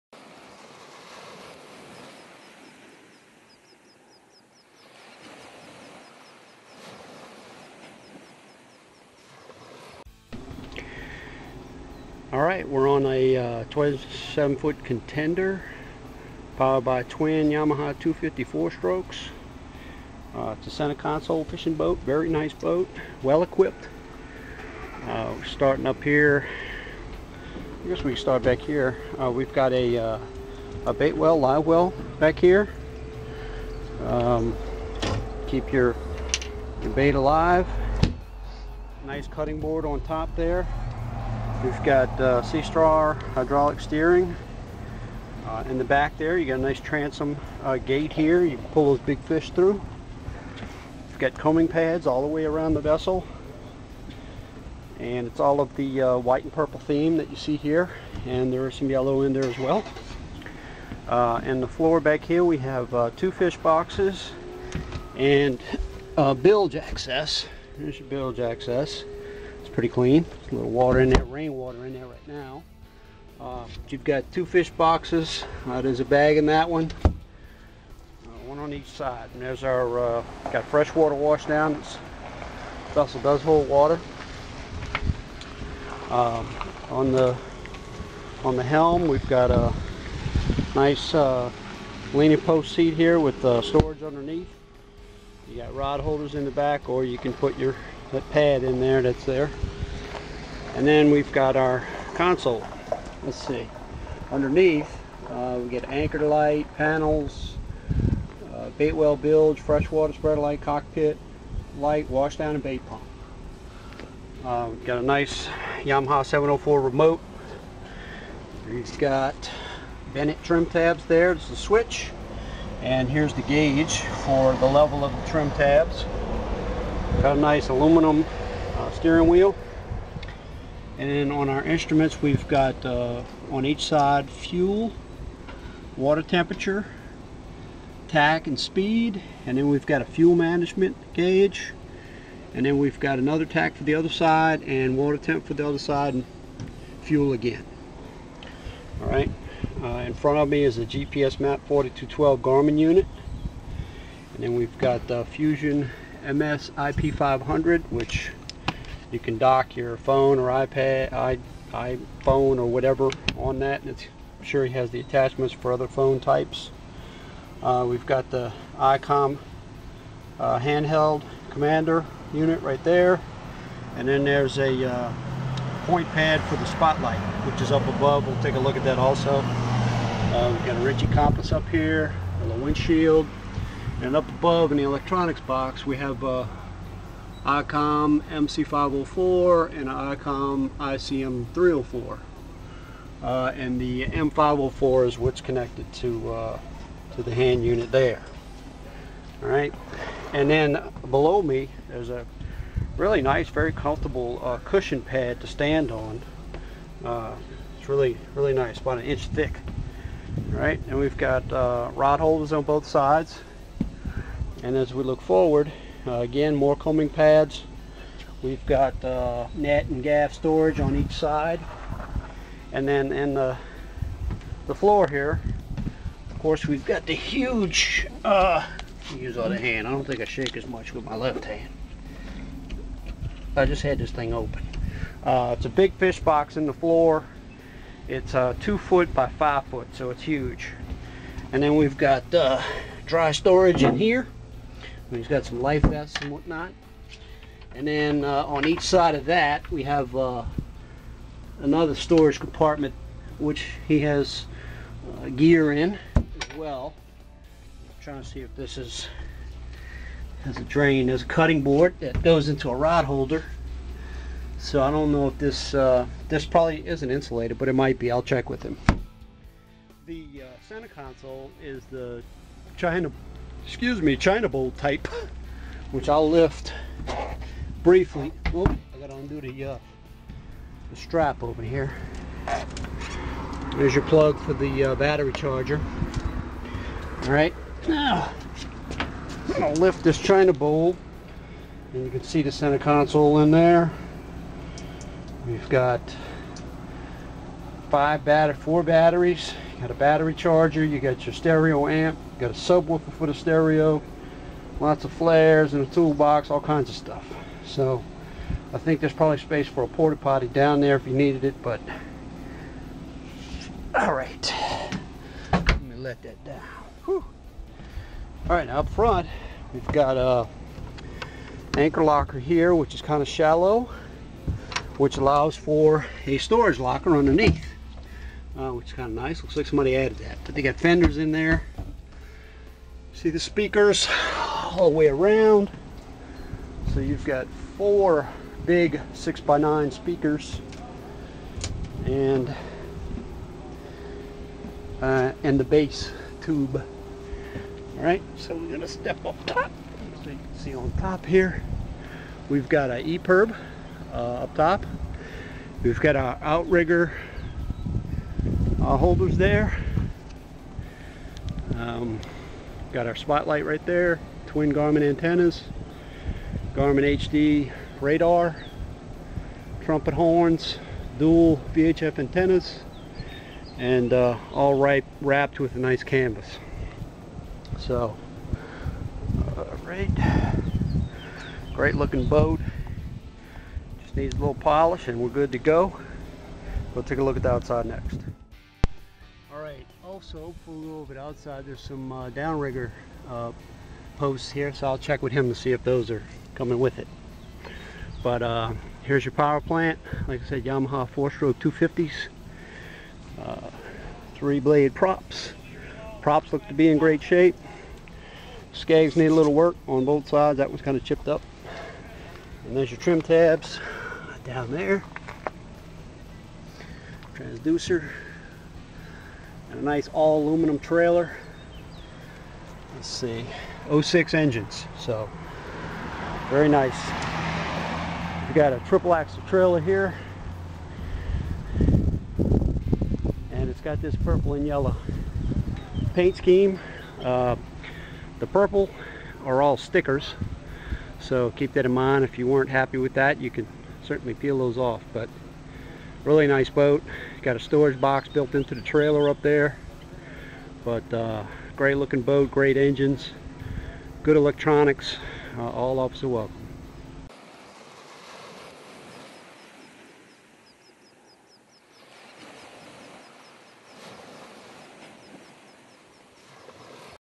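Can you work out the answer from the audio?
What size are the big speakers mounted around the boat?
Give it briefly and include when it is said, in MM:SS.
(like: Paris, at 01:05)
6 by 9, at 05:39.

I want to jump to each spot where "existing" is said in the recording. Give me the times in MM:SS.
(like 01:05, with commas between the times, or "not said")
not said.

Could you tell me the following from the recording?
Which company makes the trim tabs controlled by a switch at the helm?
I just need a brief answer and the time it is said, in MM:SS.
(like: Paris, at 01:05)
Bennett, at 02:00.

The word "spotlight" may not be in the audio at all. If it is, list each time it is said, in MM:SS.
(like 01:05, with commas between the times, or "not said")
02:56, 06:03.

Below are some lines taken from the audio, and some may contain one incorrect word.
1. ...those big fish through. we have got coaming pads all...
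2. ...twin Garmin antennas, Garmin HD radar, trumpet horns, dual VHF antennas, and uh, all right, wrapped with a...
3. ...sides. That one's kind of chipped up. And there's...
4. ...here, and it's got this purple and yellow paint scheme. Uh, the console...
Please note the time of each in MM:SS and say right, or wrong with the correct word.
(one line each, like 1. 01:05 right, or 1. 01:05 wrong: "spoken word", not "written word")
1. 00:48 right
2. 06:04 right
3. 06:50 right
4. 07:09 wrong: "purple", not "console".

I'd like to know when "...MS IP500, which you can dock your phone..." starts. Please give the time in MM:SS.
02:36.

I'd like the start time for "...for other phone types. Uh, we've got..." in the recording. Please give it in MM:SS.
02:45.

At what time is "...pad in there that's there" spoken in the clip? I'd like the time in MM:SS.
01:38.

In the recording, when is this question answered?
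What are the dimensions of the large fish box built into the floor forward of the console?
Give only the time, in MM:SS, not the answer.
03:58.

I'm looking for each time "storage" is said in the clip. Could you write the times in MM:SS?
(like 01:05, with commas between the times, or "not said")
01:33, 03:40, 04:03, 04:11, 05:26, 07:27.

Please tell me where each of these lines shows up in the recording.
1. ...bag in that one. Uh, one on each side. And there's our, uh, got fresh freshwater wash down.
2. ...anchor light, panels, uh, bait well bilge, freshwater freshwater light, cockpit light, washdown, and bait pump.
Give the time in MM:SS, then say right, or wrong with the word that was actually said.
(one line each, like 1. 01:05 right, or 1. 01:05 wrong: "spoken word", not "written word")
1. 01:16 wrong: "water", not "freshwater"
2. 01:45 wrong: "spreader", not "freshwater".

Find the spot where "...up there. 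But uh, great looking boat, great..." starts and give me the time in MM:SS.
07:29.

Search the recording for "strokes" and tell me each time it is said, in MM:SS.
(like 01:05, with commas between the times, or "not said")
00:18, 06:41.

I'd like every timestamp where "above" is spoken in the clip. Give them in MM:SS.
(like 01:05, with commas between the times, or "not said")
02:57, 03:04.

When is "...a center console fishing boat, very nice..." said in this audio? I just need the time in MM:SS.
00:20.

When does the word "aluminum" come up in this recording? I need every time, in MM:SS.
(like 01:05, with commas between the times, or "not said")
02:07, 07:00.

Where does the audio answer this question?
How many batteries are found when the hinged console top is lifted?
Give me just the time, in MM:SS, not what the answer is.
04:58.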